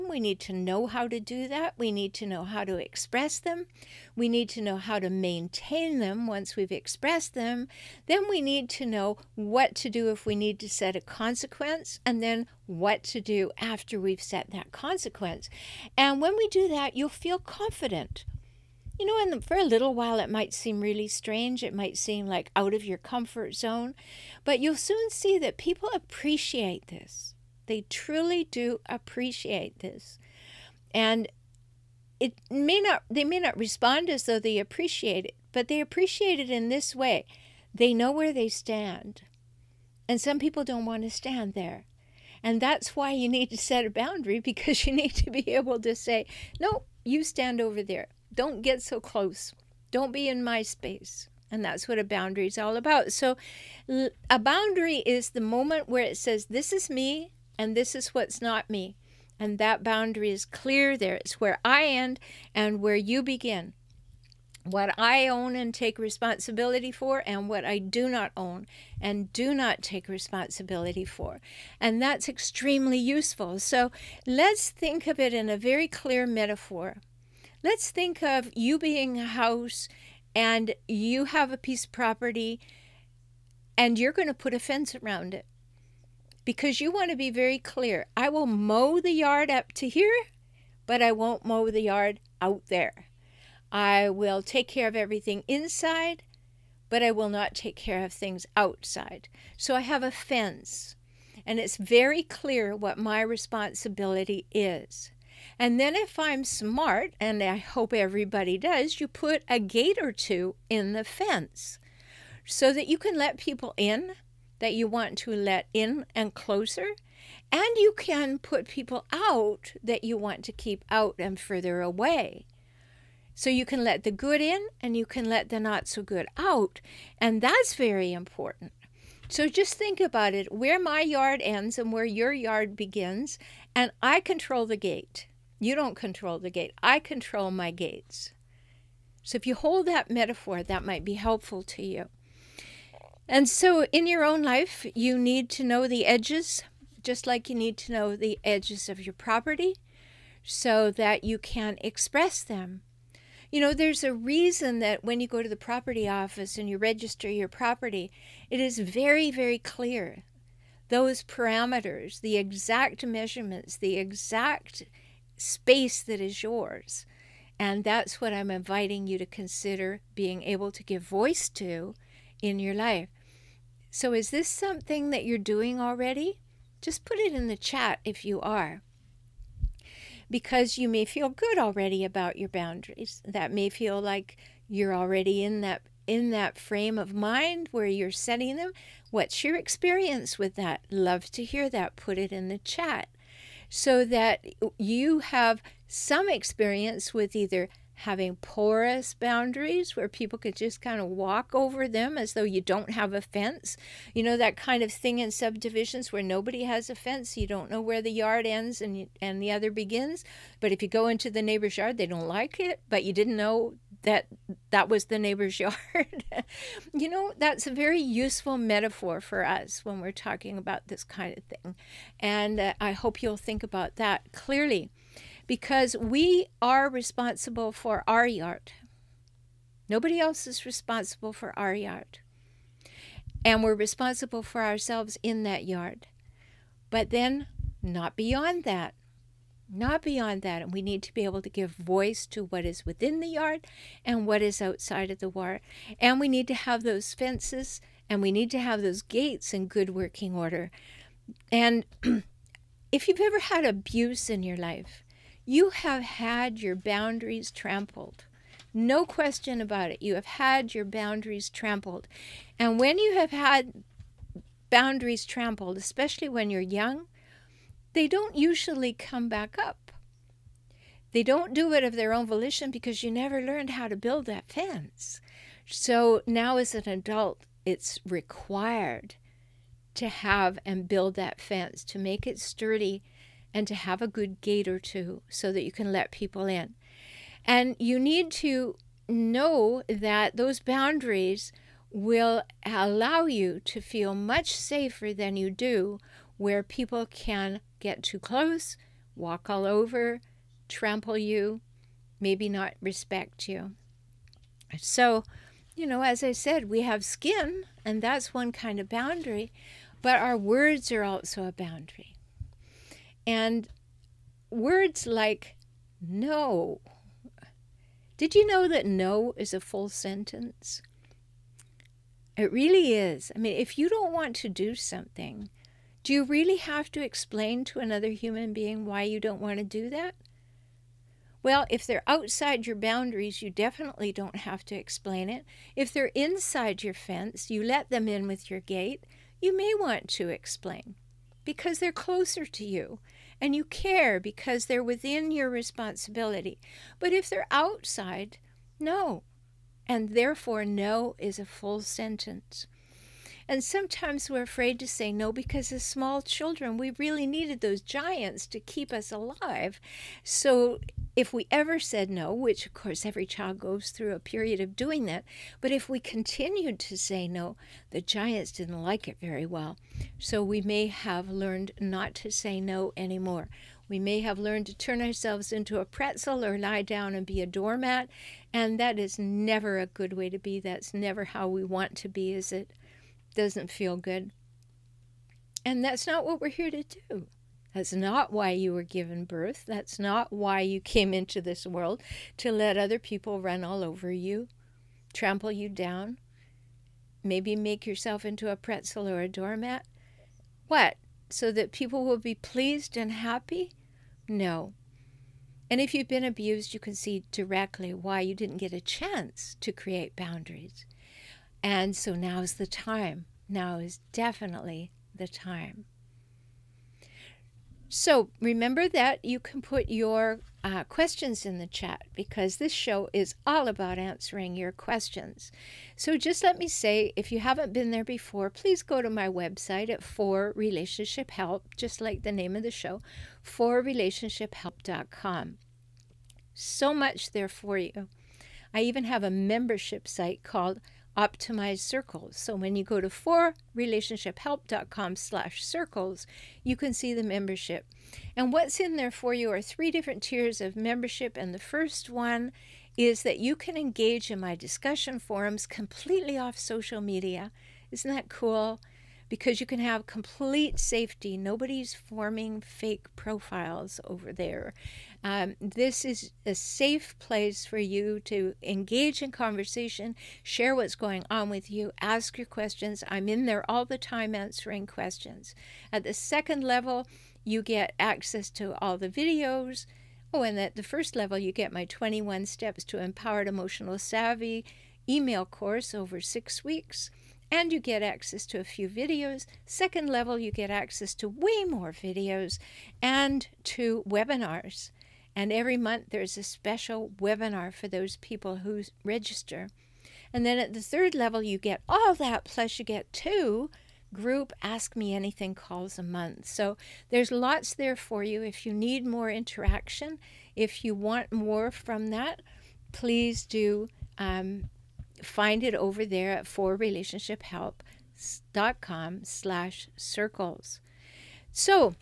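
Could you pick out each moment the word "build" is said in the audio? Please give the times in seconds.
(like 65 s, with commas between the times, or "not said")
273 s, 280 s.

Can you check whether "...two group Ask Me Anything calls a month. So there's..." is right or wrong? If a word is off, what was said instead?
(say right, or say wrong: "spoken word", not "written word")
right.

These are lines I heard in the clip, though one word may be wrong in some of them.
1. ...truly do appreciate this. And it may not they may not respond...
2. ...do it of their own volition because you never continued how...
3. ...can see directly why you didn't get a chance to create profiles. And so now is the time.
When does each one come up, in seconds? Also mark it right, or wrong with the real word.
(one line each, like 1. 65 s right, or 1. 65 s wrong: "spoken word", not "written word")
1. 27 s right
2. 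271 s wrong: "learned", not "continued"
3. 406 s wrong: "boundaries", not "profiles".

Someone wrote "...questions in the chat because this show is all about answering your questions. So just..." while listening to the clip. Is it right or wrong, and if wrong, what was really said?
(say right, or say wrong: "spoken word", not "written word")
right.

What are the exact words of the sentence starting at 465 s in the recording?
Um, this is a safe place for you to engage in conversation, share what's going on with you, ask your questions.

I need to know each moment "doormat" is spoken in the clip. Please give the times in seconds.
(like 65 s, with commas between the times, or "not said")
377 s, 399 s.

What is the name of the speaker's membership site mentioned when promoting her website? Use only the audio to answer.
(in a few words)
Optimize Circles.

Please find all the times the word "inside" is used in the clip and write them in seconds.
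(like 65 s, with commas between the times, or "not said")
95 s, 336 s.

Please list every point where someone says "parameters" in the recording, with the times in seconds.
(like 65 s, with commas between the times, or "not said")
161 s.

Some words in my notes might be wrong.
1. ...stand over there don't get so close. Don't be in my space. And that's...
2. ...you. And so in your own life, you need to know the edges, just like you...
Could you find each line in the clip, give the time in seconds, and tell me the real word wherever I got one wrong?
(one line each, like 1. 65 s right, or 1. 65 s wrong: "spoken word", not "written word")
1. 47 s right
2. 141 s right.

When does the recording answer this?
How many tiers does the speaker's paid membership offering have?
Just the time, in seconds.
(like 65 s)
449 s.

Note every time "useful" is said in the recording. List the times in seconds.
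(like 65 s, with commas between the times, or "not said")
72 s, 217 s.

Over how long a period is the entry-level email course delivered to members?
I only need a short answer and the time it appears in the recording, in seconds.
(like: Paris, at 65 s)
6 weeks, at 486 s.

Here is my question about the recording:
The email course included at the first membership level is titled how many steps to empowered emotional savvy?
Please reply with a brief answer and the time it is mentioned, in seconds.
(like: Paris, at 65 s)
21, at 481 s.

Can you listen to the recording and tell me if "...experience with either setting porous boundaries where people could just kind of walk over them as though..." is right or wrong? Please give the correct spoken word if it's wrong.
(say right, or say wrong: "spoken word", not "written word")
wrong: "having", not "setting".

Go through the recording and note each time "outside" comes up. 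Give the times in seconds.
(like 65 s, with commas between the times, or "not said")
98 s, 244 s, 332 s, 347 s.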